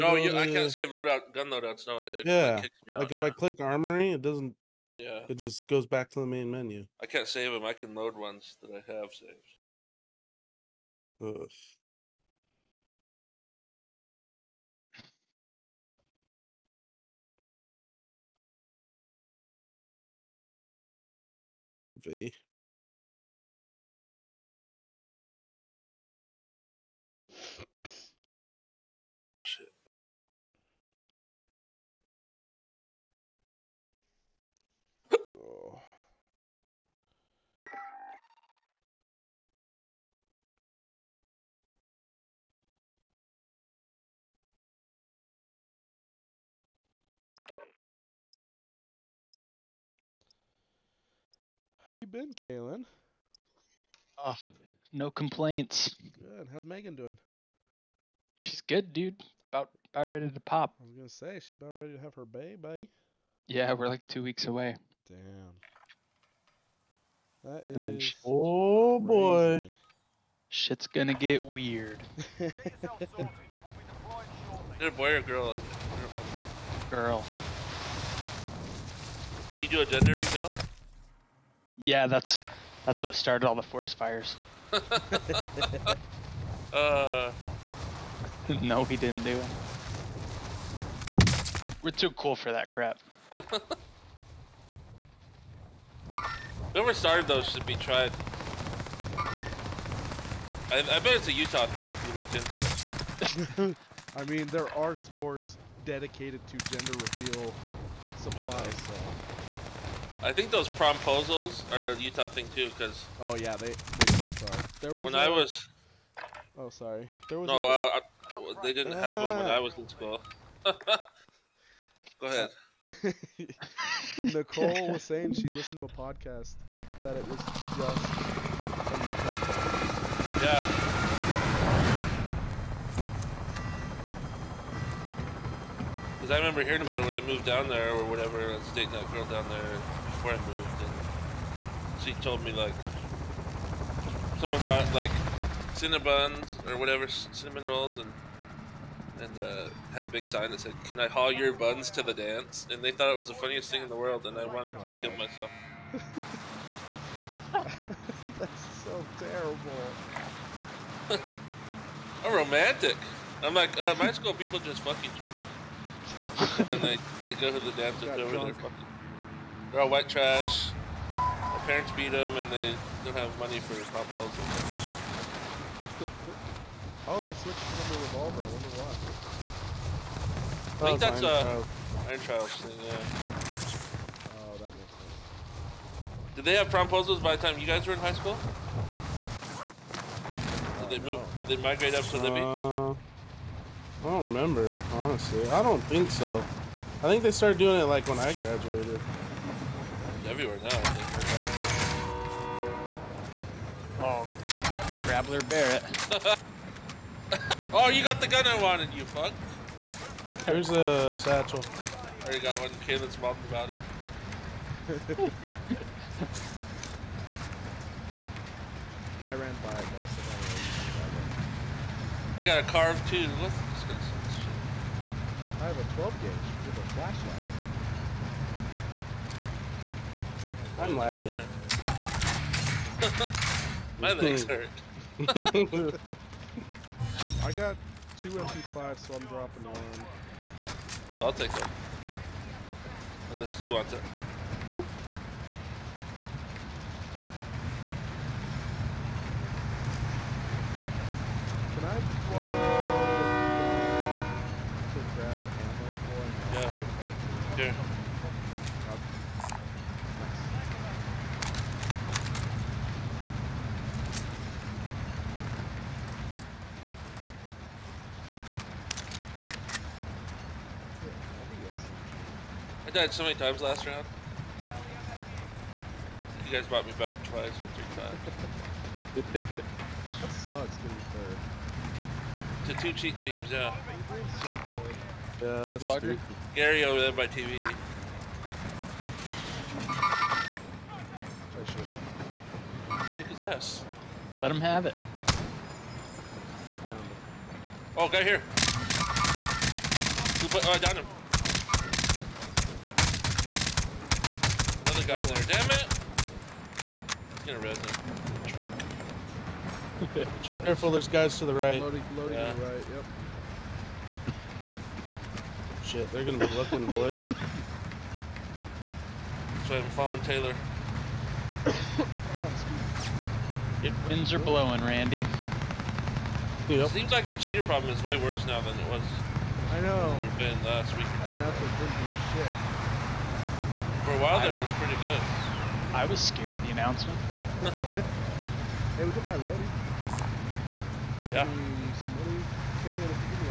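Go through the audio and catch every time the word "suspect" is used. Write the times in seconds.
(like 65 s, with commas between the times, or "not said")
not said.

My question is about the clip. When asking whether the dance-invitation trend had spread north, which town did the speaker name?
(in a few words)
Libby.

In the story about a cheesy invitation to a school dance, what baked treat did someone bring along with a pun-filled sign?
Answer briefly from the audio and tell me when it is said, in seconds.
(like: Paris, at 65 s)
Cinnabons, at 145 s.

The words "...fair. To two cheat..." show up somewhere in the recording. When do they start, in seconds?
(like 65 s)
281 s.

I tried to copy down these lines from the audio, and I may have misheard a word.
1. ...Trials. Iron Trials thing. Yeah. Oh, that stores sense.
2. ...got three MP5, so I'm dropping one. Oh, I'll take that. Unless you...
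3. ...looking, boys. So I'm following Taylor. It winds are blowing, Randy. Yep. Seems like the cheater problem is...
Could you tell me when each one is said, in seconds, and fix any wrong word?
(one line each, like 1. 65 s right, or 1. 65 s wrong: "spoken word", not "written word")
1. 181 s wrong: "makes", not "stores"
2. 237 s wrong: "two", not "three"
3. 316 s right.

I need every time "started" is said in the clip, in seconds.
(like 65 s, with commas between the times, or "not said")
83 s, 96 s, 197 s.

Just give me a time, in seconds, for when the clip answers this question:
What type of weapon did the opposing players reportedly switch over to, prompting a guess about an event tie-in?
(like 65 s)
177 s.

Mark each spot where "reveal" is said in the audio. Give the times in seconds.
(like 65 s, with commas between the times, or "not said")
80 s, 107 s.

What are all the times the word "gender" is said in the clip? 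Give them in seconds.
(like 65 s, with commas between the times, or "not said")
79 s, 106 s.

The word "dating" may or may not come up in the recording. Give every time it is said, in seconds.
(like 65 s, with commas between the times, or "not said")
138 s.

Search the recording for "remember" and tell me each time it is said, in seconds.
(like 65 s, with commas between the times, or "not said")
136 s, 194 s.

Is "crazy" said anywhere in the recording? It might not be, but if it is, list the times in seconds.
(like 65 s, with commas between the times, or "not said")
69 s.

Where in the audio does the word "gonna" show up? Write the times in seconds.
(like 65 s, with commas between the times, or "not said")
60 s, 70 s, 307 s, 316 s.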